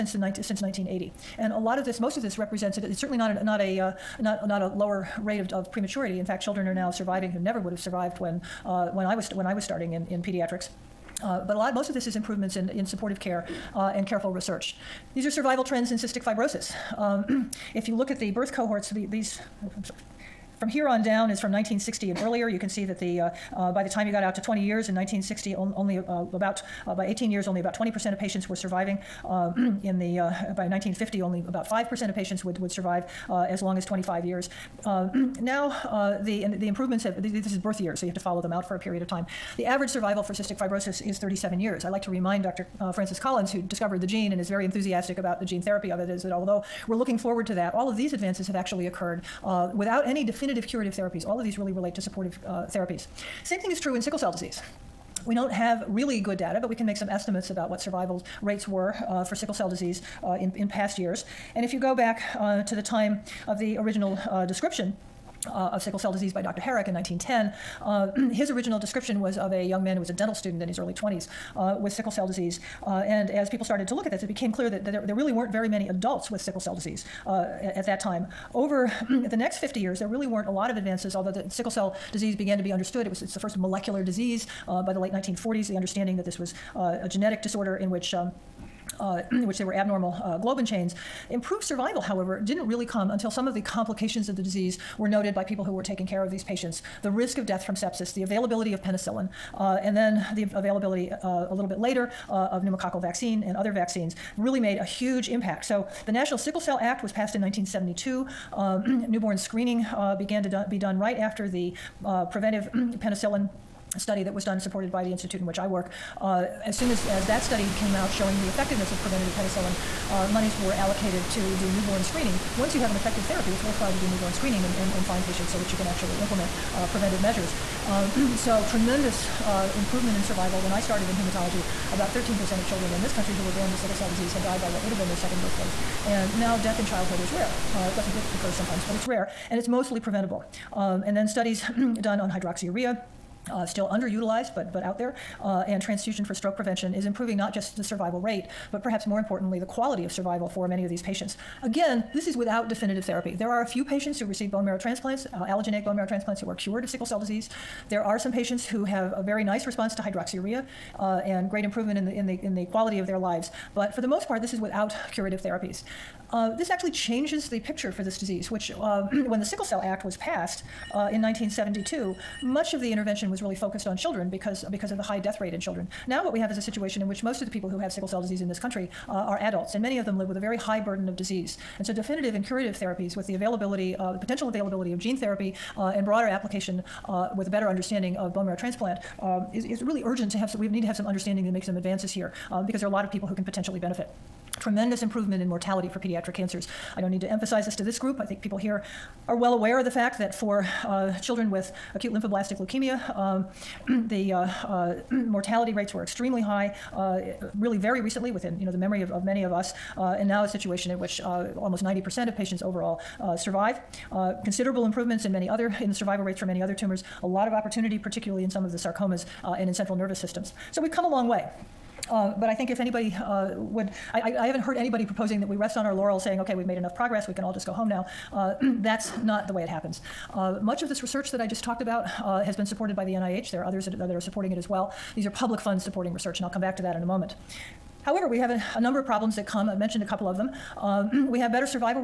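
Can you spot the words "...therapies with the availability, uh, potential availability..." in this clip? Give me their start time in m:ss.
3:02.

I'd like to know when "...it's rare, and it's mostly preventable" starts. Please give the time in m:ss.
2:18.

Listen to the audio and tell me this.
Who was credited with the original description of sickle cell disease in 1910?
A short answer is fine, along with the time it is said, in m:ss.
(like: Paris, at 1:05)
Dr. Herrick, at 1:06.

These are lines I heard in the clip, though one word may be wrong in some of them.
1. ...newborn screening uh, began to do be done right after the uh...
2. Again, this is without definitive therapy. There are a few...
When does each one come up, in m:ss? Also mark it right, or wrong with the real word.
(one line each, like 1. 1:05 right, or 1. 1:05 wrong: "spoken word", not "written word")
1. 1:49 right
2. 2:31 right.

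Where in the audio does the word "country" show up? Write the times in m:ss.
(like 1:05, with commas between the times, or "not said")
2:13, 2:58.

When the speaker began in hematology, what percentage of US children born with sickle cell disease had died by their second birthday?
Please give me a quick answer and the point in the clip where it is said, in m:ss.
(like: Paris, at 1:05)
13%, at 2:12.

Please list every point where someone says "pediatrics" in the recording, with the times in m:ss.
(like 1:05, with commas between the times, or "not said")
0:10, 3:15.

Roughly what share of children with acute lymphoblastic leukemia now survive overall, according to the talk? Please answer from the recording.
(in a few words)
almost 90%.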